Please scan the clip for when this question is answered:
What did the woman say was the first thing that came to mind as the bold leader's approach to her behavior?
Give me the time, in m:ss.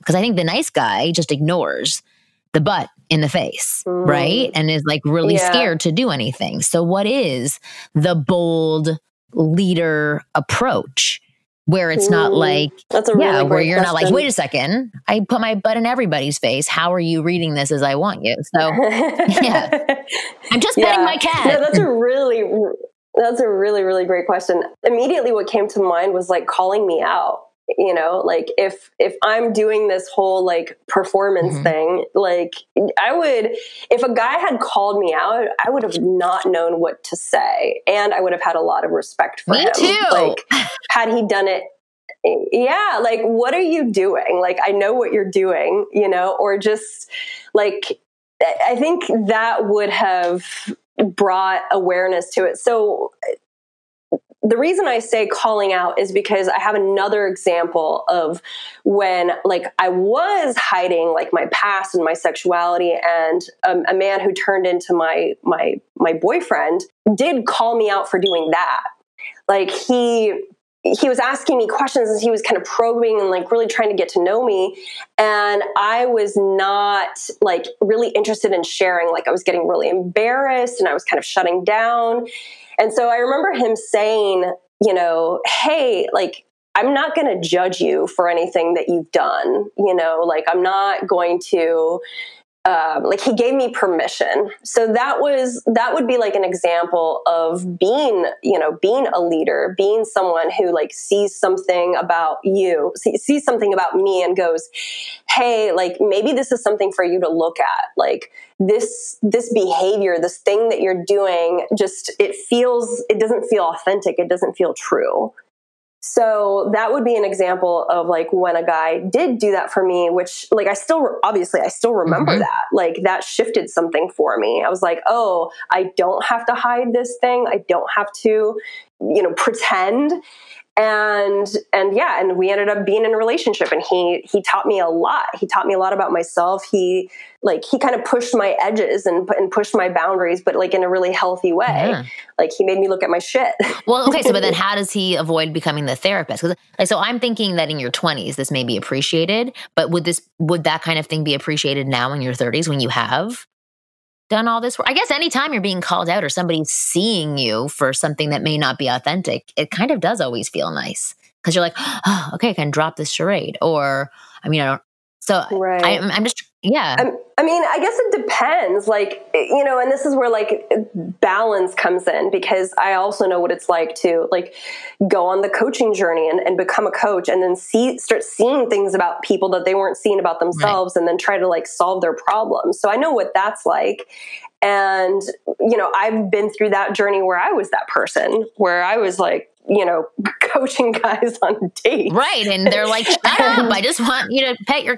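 0:26.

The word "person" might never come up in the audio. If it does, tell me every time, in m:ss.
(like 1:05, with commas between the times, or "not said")
3:07.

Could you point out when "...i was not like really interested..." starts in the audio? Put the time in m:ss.
1:15.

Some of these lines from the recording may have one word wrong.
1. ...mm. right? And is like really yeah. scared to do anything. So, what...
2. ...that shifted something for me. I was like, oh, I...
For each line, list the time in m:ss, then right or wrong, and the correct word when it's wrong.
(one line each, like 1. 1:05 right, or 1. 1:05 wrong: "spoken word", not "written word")
1. 0:03 right
2. 2:03 right.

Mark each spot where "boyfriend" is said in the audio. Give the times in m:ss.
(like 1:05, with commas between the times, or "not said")
1:06.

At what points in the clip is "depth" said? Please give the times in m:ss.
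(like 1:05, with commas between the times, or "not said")
not said.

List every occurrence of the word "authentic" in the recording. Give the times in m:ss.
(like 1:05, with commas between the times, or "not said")
1:53, 2:38.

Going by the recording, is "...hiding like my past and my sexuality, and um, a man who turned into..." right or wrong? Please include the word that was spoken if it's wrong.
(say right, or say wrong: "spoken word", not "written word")
right.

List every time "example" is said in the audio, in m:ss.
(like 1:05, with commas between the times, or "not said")
0:57, 1:36, 1:57.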